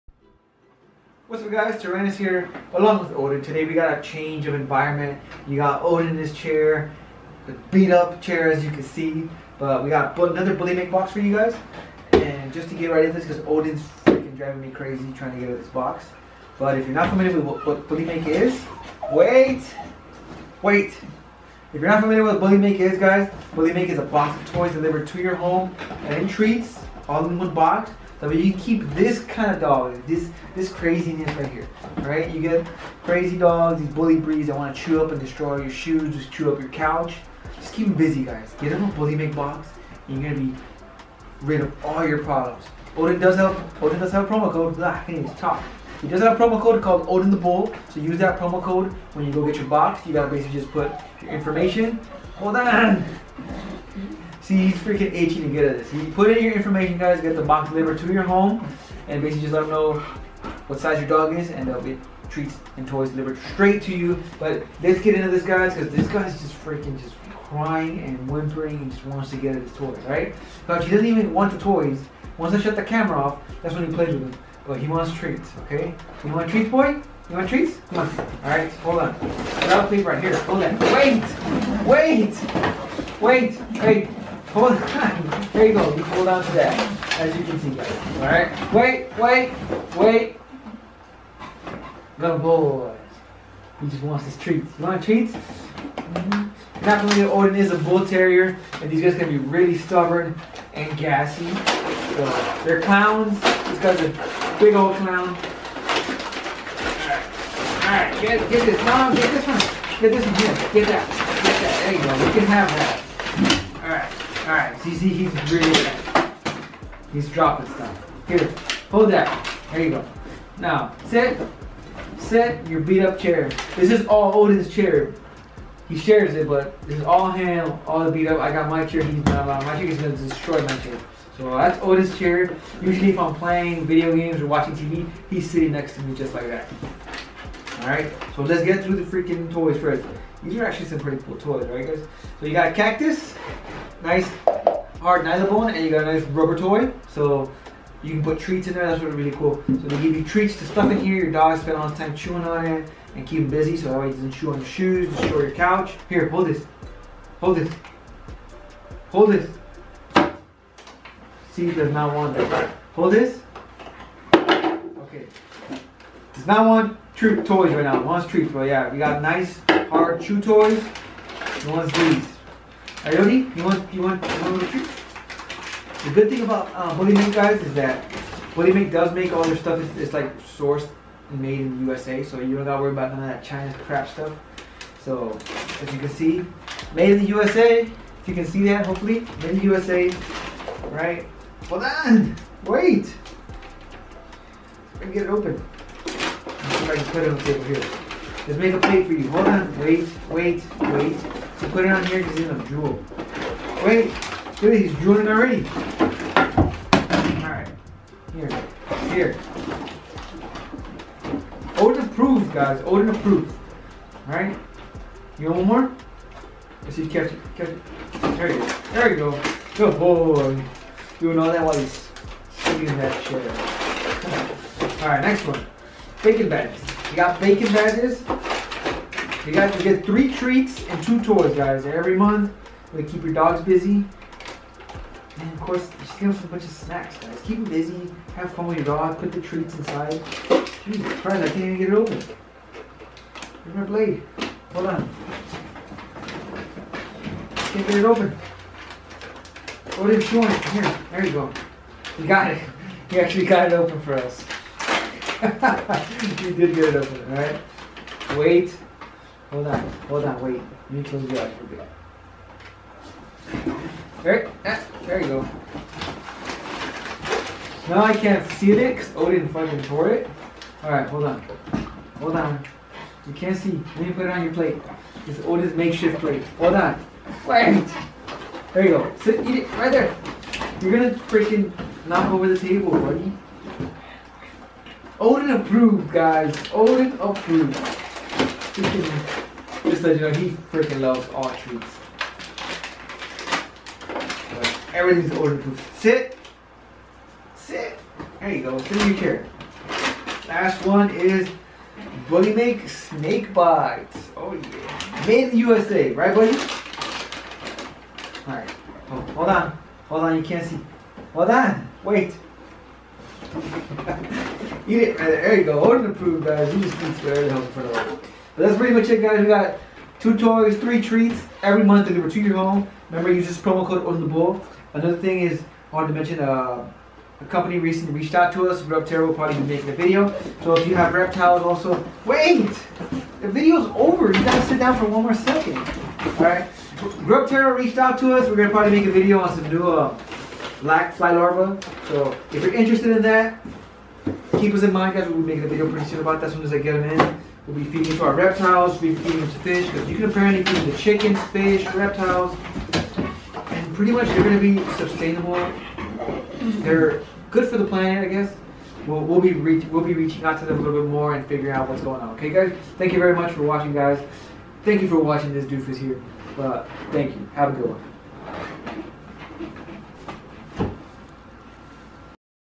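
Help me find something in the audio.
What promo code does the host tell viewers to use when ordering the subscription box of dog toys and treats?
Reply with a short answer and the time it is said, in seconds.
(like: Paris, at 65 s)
Odin the Bull, at 47 s.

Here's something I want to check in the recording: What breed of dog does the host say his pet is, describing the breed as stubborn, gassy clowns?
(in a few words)
Bull terrier.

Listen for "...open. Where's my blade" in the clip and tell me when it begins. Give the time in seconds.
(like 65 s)
241 s.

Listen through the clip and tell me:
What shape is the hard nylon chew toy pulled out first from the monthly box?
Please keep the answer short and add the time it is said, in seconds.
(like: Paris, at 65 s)
Cactus, at 142 s.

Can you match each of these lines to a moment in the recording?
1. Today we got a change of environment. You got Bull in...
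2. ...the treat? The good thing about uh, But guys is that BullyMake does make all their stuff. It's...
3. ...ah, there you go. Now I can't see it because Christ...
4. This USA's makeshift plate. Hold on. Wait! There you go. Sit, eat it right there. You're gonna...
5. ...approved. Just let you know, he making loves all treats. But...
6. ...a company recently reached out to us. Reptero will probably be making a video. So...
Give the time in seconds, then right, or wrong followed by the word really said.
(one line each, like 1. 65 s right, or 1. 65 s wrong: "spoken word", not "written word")
1. 3 s wrong: "Odin", not "Bull"
2. 174 s wrong: "BullyMake", not "But"
3. 264 s wrong: "Odin", not "Christ"
4. 275 s wrong: "Odin", not "USA"
5. 287 s wrong: "freaking", not "making"
6. 327 s right.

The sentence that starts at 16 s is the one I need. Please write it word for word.
But if you're not familiar with what, what BullyMake is, wait, wait.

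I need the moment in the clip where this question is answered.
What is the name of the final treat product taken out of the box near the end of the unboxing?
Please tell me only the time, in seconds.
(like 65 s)
302 s.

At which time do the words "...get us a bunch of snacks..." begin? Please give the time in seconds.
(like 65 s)
236 s.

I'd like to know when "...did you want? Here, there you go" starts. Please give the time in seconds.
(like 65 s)
250 s.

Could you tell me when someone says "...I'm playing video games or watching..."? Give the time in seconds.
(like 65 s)
133 s.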